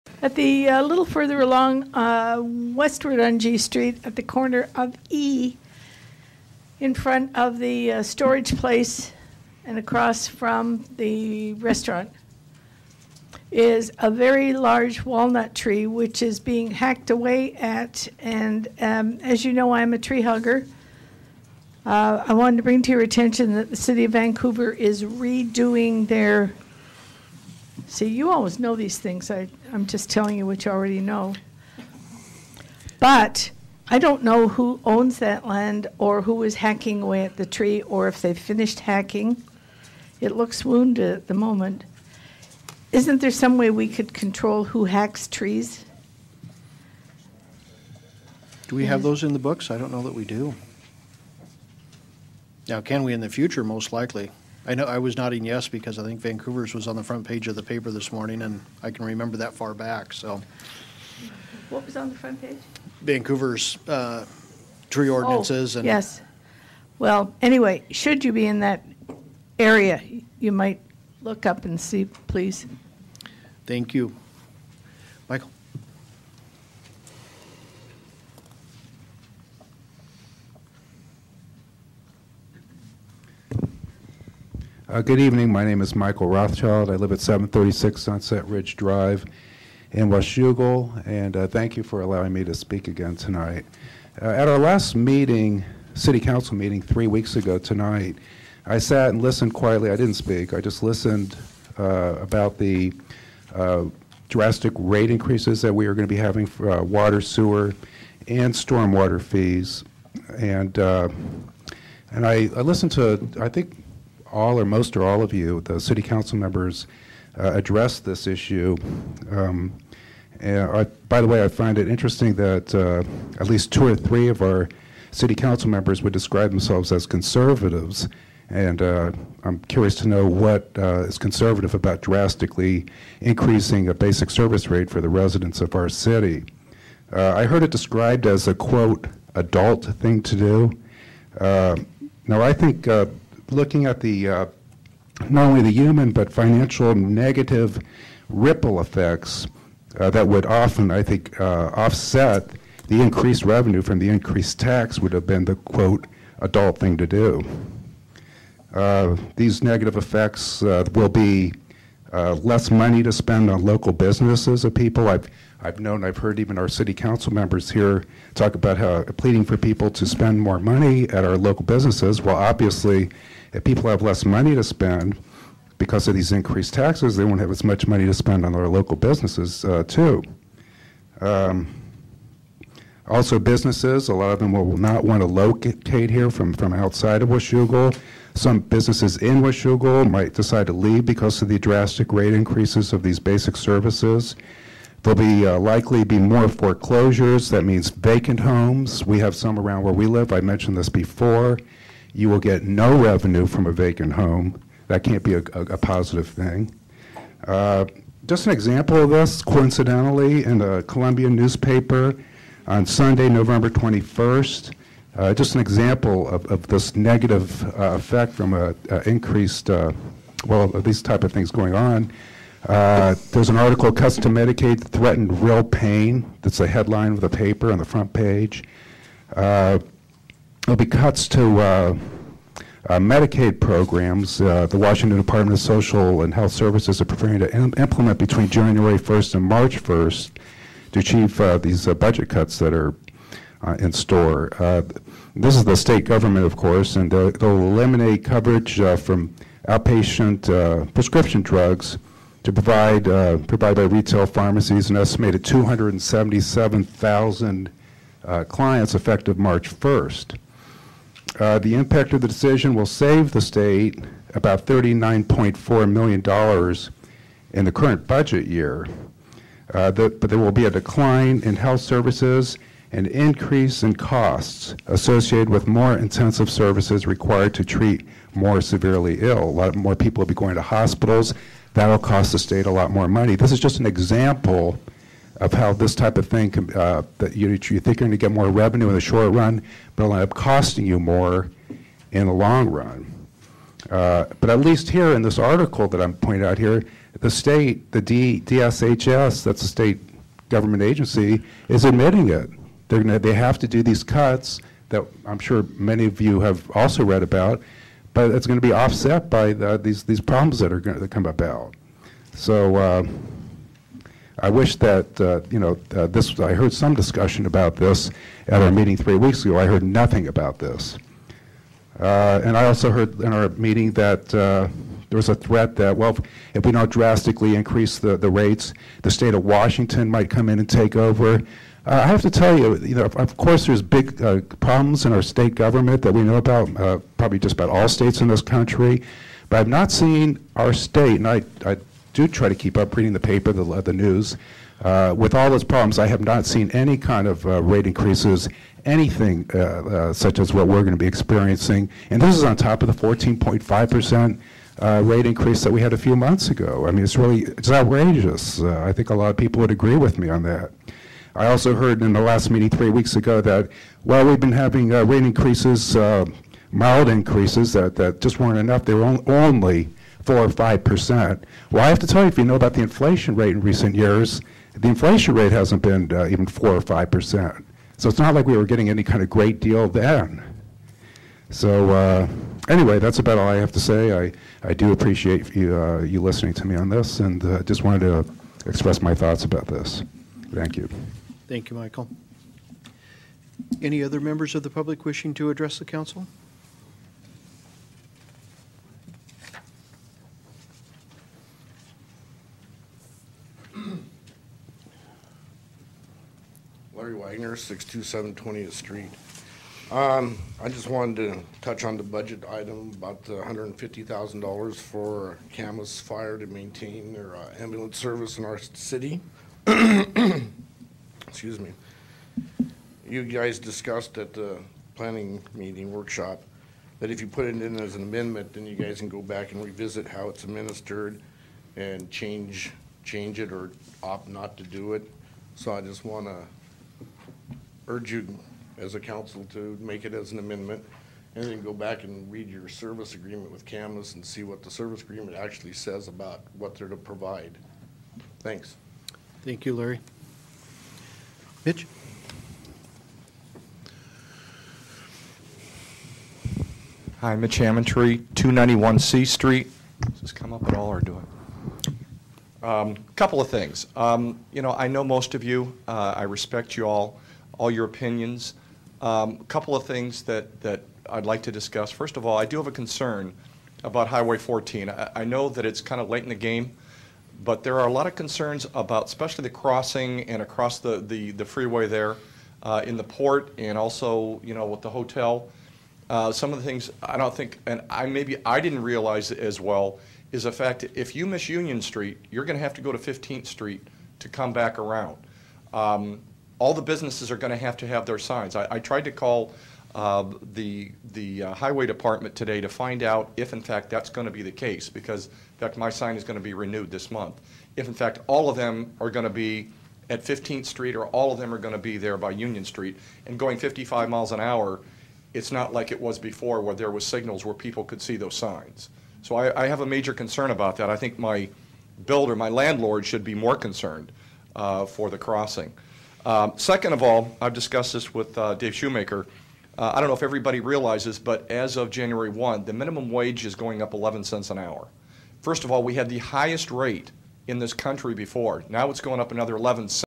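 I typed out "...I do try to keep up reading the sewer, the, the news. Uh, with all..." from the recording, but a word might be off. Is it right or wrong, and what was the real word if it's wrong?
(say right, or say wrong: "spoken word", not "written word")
wrong: "paper", not "sewer".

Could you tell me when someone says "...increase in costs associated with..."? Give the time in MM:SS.
04:33.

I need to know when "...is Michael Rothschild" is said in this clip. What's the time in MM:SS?
01:25.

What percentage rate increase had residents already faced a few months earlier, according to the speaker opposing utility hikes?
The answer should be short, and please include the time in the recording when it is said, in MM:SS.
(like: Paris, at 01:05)
14.5%, at 05:53.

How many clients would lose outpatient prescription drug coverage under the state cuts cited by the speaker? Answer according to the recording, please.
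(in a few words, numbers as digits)
277,000.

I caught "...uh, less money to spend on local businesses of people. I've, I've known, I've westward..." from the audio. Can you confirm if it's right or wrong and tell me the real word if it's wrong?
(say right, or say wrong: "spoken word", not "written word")
wrong: "heard", not "westward".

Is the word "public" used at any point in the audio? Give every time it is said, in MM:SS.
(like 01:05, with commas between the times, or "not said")
06:34.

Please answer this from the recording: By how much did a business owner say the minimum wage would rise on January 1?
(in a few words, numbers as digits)
11 cents an hour.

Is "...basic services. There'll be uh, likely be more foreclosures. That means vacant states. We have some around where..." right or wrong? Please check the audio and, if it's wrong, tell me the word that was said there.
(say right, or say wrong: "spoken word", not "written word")
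wrong: "homes", not "states".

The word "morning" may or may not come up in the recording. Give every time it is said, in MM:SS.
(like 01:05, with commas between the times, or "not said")
00:58.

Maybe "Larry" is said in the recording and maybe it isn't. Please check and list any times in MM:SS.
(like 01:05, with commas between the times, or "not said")
06:46, 07:29.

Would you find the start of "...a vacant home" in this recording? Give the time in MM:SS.
03:23.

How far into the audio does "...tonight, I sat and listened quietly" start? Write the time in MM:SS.
01:37.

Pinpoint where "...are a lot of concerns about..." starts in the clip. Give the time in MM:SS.
07:57.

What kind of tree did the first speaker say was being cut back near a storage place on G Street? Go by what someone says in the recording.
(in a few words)
Walnut.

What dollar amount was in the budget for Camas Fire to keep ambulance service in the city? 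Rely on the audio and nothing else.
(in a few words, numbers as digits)
$150,000.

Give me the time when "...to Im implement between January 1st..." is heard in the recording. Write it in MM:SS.
03:57.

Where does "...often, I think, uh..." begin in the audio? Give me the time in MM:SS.
02:30.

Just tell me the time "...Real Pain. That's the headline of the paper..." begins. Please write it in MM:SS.
03:45.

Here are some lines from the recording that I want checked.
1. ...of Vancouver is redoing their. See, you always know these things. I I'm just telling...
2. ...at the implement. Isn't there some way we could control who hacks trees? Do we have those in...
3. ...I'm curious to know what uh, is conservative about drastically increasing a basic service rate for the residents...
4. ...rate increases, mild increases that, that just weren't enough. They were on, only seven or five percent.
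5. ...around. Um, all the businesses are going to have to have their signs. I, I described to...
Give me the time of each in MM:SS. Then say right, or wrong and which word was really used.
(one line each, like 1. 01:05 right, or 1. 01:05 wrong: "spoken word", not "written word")
1. 00:24 right
2. 00:41 wrong: "moment", not "implement"
3. 02:09 right
4. 06:04 wrong: "four", not "seven"
5. 08:14 wrong: "tried", not "described".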